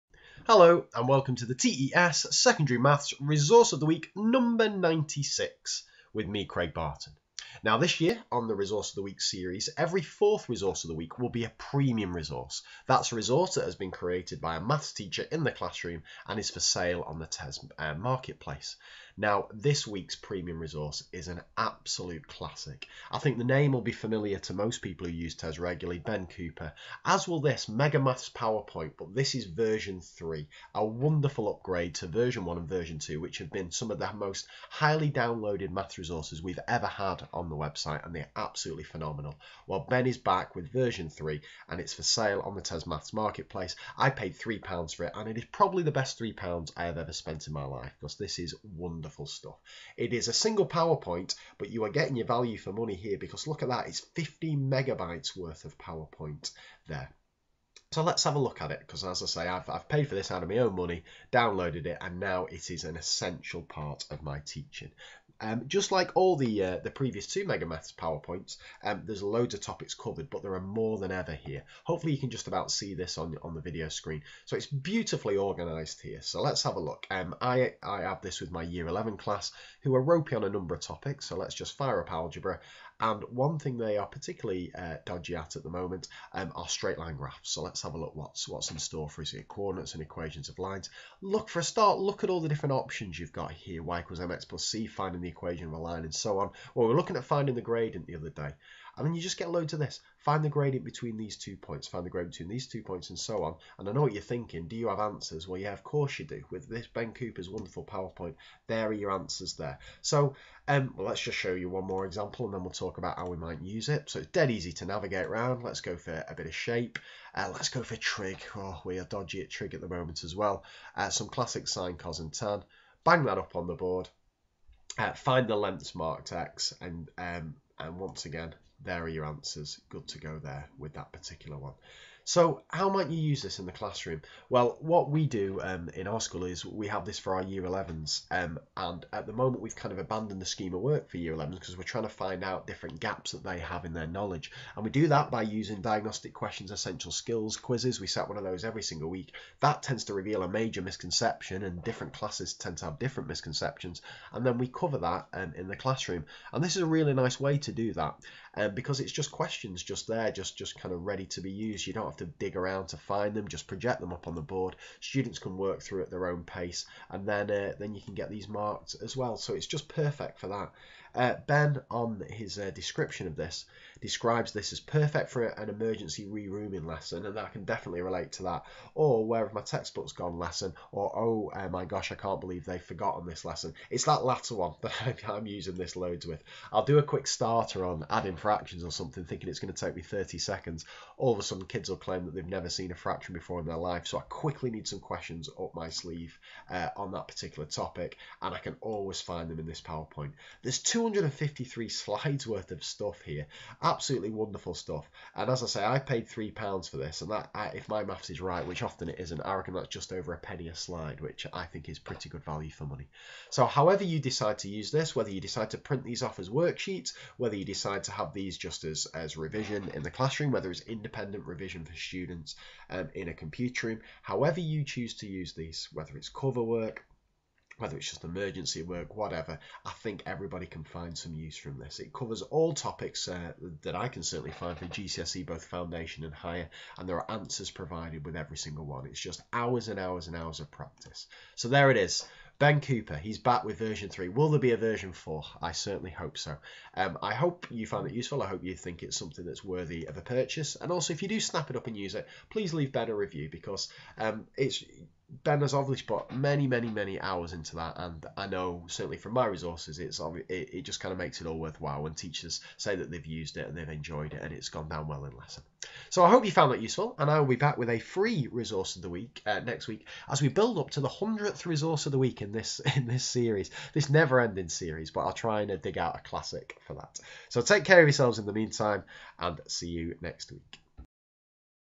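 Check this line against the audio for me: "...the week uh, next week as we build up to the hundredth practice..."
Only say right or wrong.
wrong.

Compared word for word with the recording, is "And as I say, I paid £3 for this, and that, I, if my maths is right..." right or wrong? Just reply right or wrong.
right.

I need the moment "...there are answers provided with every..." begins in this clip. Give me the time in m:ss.
3:57.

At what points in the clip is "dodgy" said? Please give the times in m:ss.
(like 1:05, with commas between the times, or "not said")
1:25, 1:59.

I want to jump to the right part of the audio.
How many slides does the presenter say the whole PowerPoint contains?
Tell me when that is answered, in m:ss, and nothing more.
3:20.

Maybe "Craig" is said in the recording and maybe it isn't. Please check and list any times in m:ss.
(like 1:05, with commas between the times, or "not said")
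0:06.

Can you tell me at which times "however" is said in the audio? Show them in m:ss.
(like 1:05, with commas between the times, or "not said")
3:33, 3:44.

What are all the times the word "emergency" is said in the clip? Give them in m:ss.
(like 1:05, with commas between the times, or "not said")
2:55, 3:48.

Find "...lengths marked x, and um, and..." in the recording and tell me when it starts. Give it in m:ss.
2:05.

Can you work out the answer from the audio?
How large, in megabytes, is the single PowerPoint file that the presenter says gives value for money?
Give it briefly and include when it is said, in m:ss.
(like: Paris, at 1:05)
15 megabytes, at 0:54.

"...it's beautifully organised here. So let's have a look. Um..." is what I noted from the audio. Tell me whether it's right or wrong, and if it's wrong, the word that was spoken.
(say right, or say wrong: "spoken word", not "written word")
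right.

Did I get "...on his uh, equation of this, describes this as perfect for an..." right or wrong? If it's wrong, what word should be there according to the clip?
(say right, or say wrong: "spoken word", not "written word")
wrong: "description", not "equation".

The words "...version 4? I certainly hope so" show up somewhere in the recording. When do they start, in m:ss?
4:04.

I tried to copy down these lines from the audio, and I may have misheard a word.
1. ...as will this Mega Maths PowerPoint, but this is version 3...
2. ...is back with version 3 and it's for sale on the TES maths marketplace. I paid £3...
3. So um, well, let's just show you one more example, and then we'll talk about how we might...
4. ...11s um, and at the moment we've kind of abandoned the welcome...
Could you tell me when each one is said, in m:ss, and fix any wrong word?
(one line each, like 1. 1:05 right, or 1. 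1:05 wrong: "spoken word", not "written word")
1. 0:27 right
2. 0:40 right
3. 1:50 right
4. 2:17 wrong: "scheme", not "welcome".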